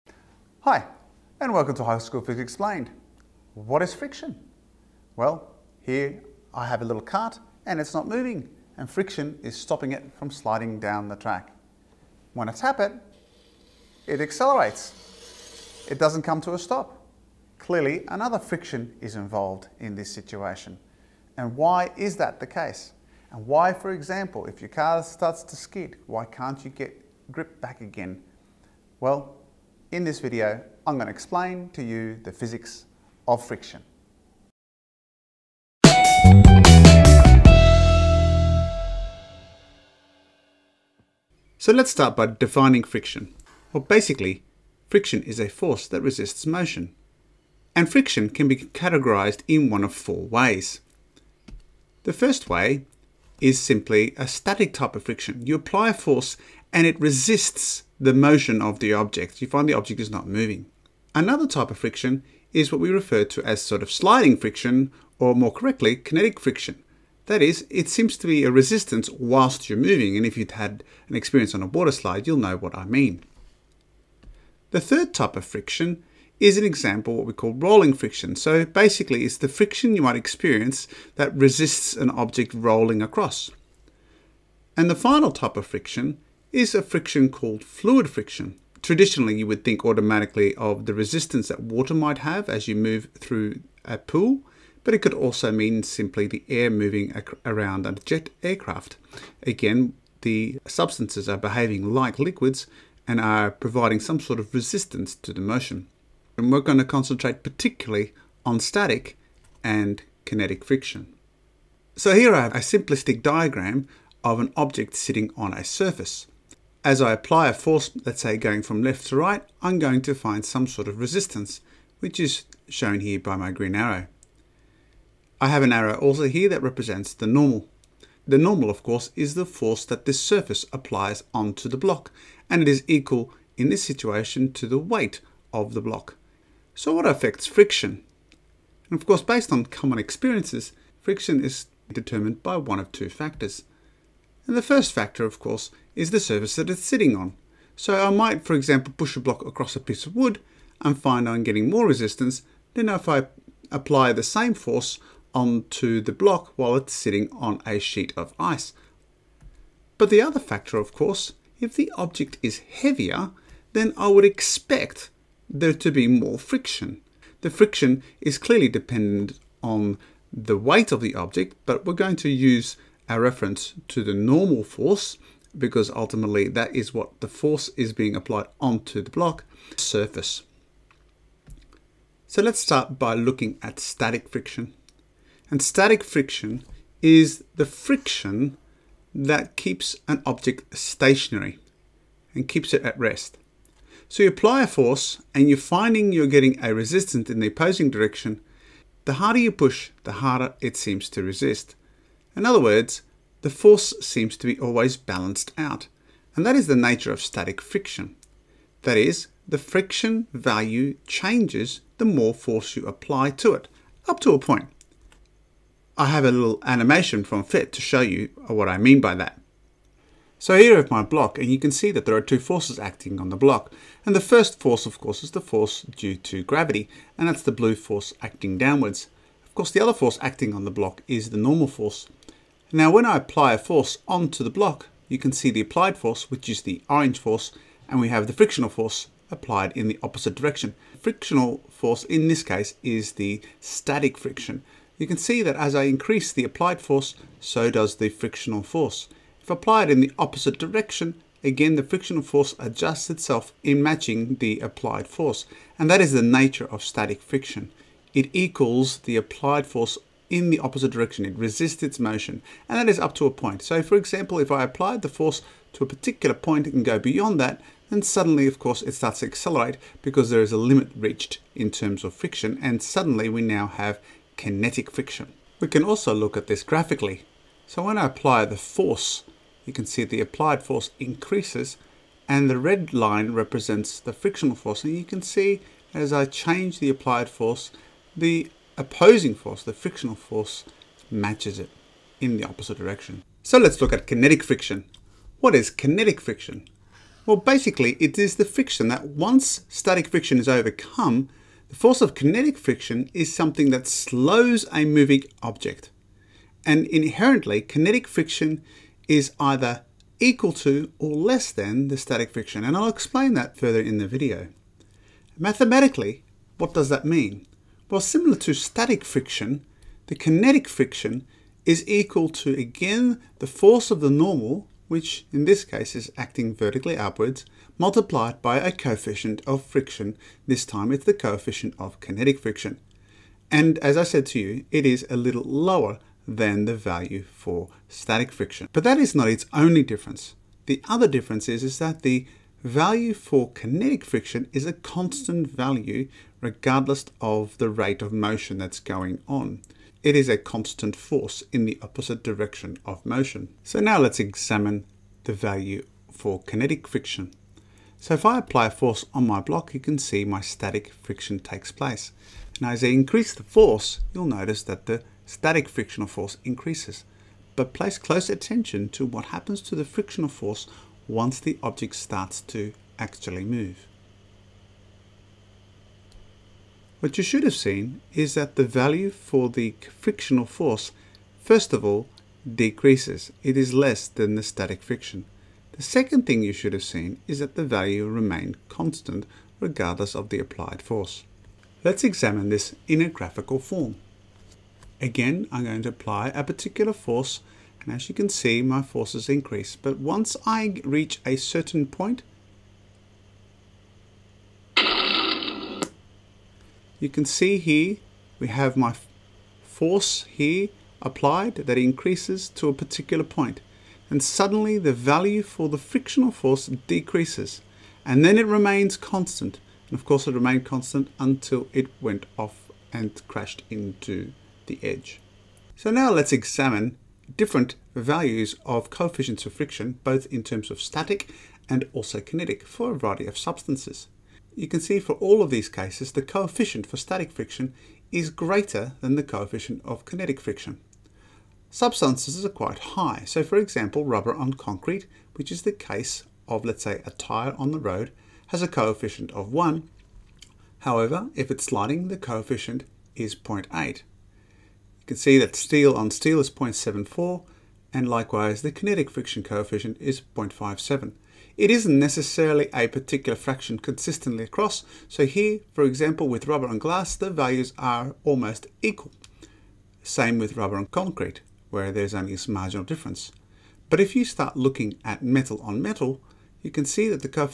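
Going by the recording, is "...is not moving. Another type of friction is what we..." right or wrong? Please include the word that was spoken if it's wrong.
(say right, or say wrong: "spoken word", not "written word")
right.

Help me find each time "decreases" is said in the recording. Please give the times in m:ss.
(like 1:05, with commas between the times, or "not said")
6:22, 6:56.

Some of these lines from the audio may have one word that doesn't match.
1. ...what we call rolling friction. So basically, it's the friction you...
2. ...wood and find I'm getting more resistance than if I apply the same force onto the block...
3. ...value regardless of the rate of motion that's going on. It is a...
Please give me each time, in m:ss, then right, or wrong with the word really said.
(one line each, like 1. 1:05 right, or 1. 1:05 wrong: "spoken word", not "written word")
1. 1:17 right
2. 2:30 right
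3. 5:45 right.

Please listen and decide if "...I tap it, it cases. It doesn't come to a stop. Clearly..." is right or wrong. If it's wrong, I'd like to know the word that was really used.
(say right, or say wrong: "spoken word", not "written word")
wrong: "accelerates", not "cases".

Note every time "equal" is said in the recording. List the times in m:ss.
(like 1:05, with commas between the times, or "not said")
2:12, 4:18, 5:10, 5:21, 7:48.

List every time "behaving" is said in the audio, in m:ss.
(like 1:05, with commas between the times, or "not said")
1:41.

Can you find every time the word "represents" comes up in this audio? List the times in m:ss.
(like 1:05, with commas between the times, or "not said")
2:06, 4:43.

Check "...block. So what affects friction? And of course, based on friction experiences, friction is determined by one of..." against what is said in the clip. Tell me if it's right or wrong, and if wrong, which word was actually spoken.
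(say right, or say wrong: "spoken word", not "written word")
wrong: "common", not "friction".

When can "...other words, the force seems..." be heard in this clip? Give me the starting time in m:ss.
3:22.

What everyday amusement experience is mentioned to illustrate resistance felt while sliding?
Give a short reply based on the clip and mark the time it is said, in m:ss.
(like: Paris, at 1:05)
water slide, at 1:11.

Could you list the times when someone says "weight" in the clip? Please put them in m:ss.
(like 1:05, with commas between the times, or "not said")
2:14, 2:50.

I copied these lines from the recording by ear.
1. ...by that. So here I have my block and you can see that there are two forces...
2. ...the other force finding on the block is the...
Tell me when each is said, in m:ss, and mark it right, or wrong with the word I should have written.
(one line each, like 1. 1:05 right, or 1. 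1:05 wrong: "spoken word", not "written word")
1. 3:39 right
2. 3:49 wrong: "acting", not "finding".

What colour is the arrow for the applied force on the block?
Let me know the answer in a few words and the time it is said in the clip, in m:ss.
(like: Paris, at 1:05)
orange, at 3:56.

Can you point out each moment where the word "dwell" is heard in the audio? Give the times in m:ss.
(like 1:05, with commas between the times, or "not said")
not said.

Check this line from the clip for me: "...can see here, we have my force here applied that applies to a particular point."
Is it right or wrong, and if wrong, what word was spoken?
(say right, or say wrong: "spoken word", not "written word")
wrong: "increases", not "applies".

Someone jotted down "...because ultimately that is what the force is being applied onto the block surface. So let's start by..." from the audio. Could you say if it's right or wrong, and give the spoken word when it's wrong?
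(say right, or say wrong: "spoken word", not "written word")
right.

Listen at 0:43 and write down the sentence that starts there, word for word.
Well, basically, friction is a force that resists motion.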